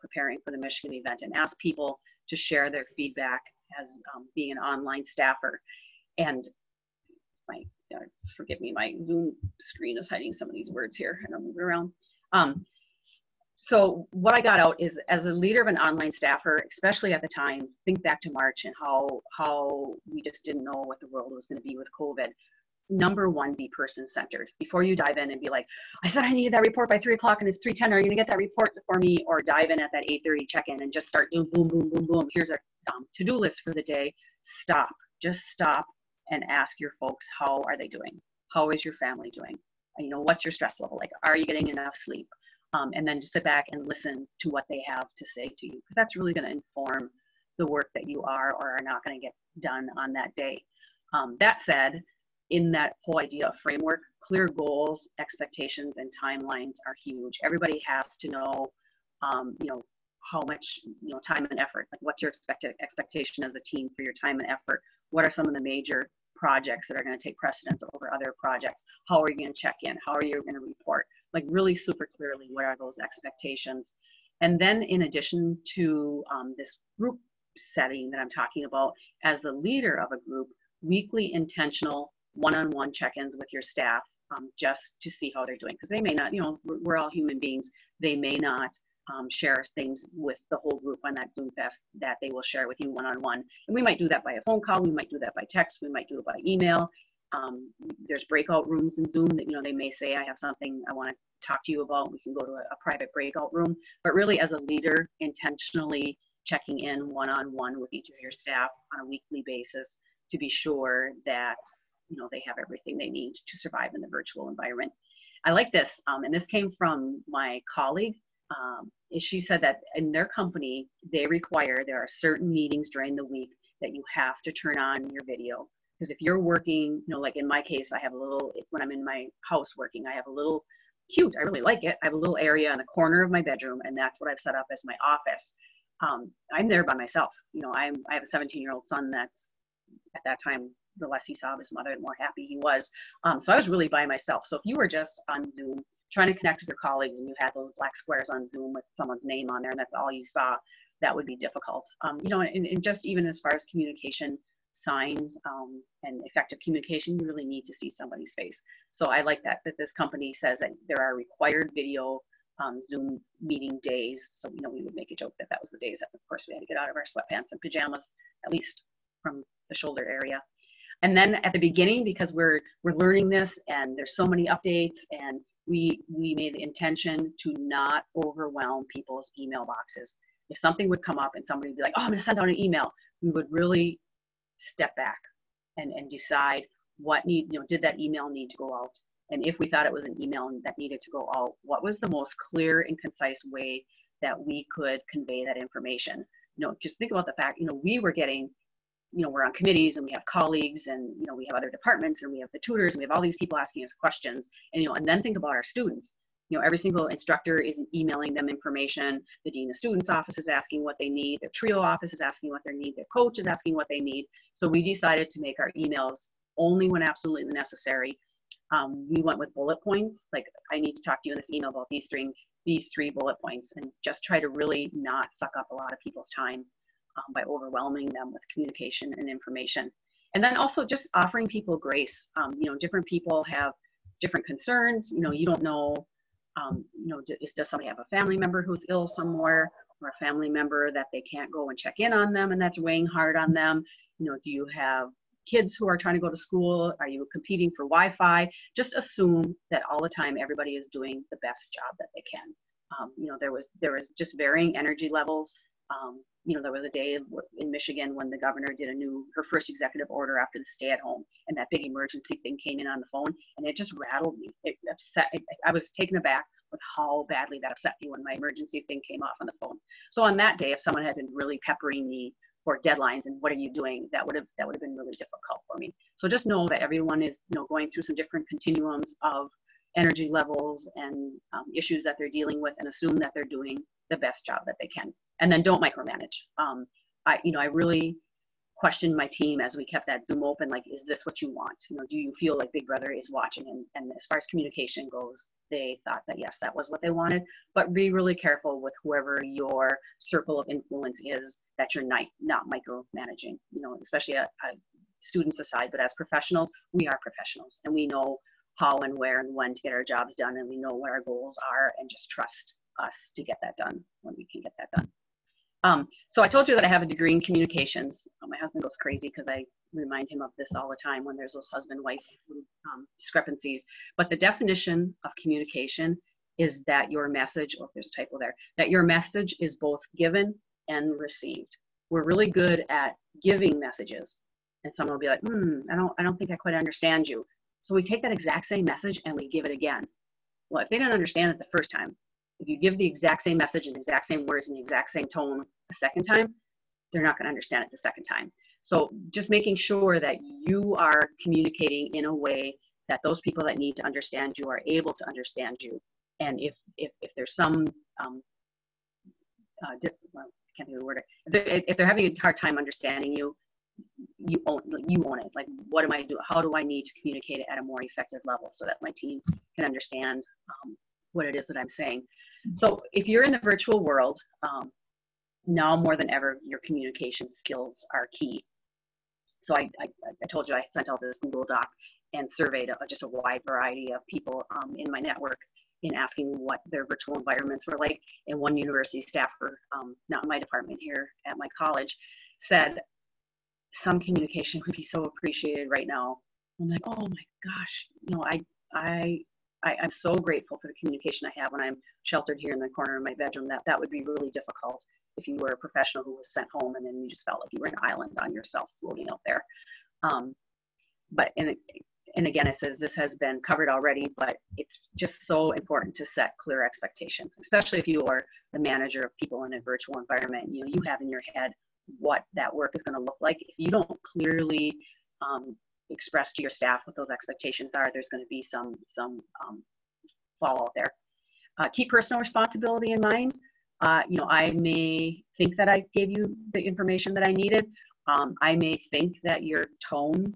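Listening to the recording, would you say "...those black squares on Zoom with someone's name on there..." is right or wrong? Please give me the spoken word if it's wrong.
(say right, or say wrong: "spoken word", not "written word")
right.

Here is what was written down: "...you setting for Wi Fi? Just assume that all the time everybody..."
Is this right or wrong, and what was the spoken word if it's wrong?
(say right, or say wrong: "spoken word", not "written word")
wrong: "competing", not "setting".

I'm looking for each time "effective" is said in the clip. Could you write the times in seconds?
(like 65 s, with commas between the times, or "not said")
156 s, 368 s.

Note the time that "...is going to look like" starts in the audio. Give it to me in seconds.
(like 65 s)
422 s.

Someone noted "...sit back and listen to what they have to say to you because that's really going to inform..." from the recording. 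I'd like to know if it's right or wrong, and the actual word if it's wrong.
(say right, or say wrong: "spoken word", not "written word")
right.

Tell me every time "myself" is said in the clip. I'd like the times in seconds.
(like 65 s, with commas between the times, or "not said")
136 s, 144 s.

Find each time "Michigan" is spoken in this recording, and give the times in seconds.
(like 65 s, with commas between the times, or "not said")
0 s, 257 s.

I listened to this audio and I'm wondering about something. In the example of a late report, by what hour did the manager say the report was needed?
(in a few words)
3:00.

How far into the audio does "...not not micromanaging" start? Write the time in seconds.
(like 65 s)
302 s.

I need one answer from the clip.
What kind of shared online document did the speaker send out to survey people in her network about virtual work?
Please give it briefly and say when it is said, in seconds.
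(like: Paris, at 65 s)
Google Doc, at 381 s.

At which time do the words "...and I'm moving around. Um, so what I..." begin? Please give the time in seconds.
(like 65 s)
11 s.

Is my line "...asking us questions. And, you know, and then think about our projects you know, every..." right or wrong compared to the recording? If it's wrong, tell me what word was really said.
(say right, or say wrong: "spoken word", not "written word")
wrong: "students", not "projects".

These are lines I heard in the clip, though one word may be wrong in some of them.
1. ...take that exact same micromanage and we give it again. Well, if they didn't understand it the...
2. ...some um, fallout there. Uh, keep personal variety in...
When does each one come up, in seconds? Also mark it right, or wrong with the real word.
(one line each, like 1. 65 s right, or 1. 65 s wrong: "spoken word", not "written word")
1. 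338 s wrong: "message", not "micromanage"
2. 429 s wrong: "responsibility", not "variety".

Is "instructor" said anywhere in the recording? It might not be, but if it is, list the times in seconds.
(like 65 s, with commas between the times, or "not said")
207 s.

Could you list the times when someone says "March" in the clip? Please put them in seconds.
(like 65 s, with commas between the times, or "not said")
18 s.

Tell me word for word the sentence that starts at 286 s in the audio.
Um, I, you know, I really questioned my team as we kept that Zoom open.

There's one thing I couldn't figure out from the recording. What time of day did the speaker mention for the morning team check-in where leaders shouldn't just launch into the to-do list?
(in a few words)
8:30.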